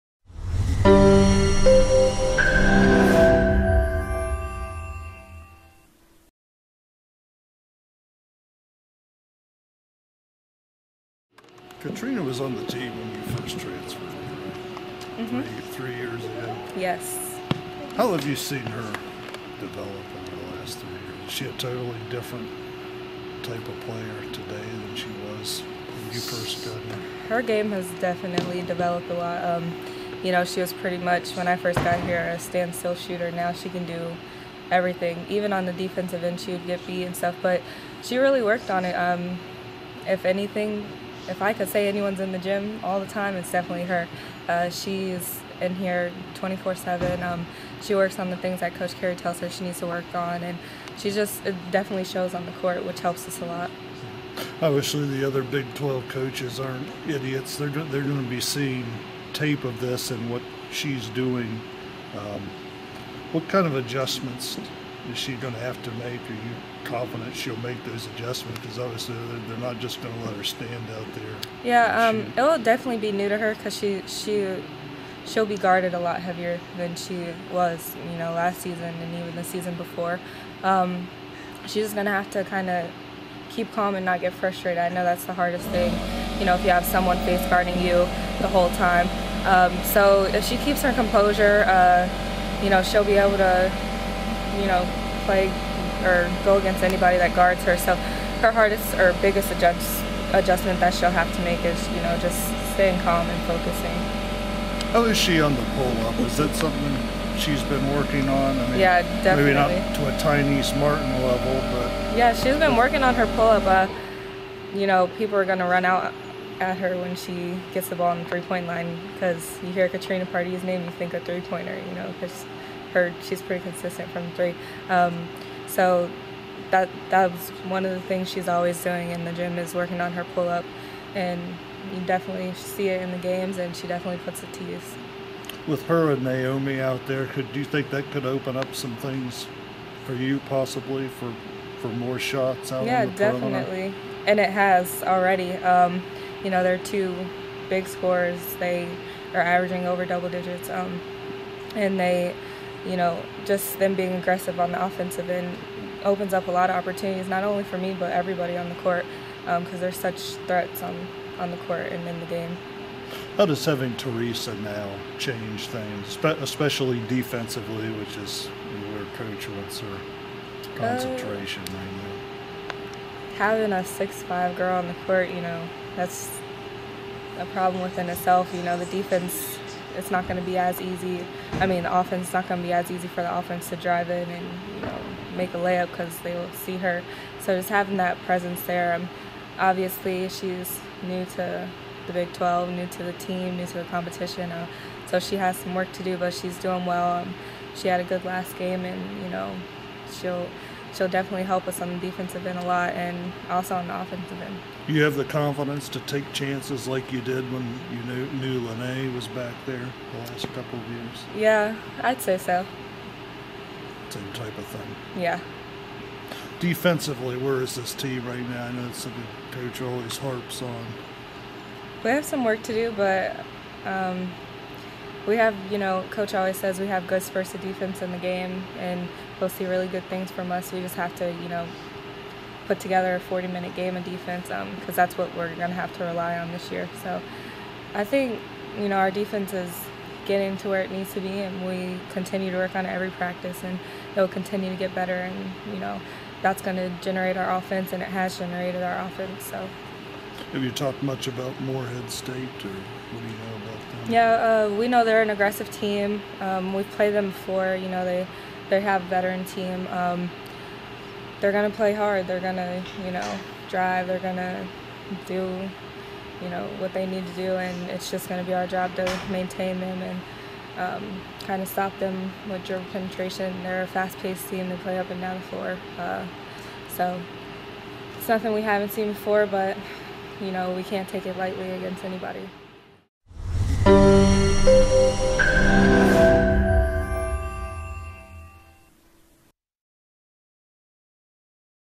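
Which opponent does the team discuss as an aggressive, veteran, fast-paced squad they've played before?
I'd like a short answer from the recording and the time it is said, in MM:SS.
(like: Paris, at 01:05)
Morehead State, at 04:11.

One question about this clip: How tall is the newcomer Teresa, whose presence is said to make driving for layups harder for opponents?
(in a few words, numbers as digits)
6-5.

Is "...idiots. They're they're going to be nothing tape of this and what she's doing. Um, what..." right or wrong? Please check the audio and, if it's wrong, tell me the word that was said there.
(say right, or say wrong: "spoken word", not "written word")
wrong: "seeing", not "nothing".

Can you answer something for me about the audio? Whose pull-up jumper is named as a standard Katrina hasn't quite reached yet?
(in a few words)
Tynice Martin.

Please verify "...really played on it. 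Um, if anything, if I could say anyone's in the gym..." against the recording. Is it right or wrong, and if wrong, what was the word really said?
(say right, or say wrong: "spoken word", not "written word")
wrong: "worked", not "played".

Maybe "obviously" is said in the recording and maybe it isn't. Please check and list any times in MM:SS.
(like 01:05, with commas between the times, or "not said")
00:54, 01:08, 03:09.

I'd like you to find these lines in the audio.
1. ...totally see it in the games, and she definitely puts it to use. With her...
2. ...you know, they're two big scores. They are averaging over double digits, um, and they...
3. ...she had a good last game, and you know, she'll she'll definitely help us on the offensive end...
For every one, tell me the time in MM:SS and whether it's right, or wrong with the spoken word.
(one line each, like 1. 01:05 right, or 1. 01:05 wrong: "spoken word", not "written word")
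1. 02:12 wrong: "definitely", not "totally"
2. 02:26 right
3. 03:17 wrong: "defensive", not "offensive".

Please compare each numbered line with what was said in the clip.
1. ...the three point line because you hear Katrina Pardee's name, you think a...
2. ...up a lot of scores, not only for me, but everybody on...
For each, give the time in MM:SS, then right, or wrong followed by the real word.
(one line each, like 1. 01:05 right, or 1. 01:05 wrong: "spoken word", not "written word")
1. 01:58 right
2. 02:36 wrong: "opportunities", not "scores".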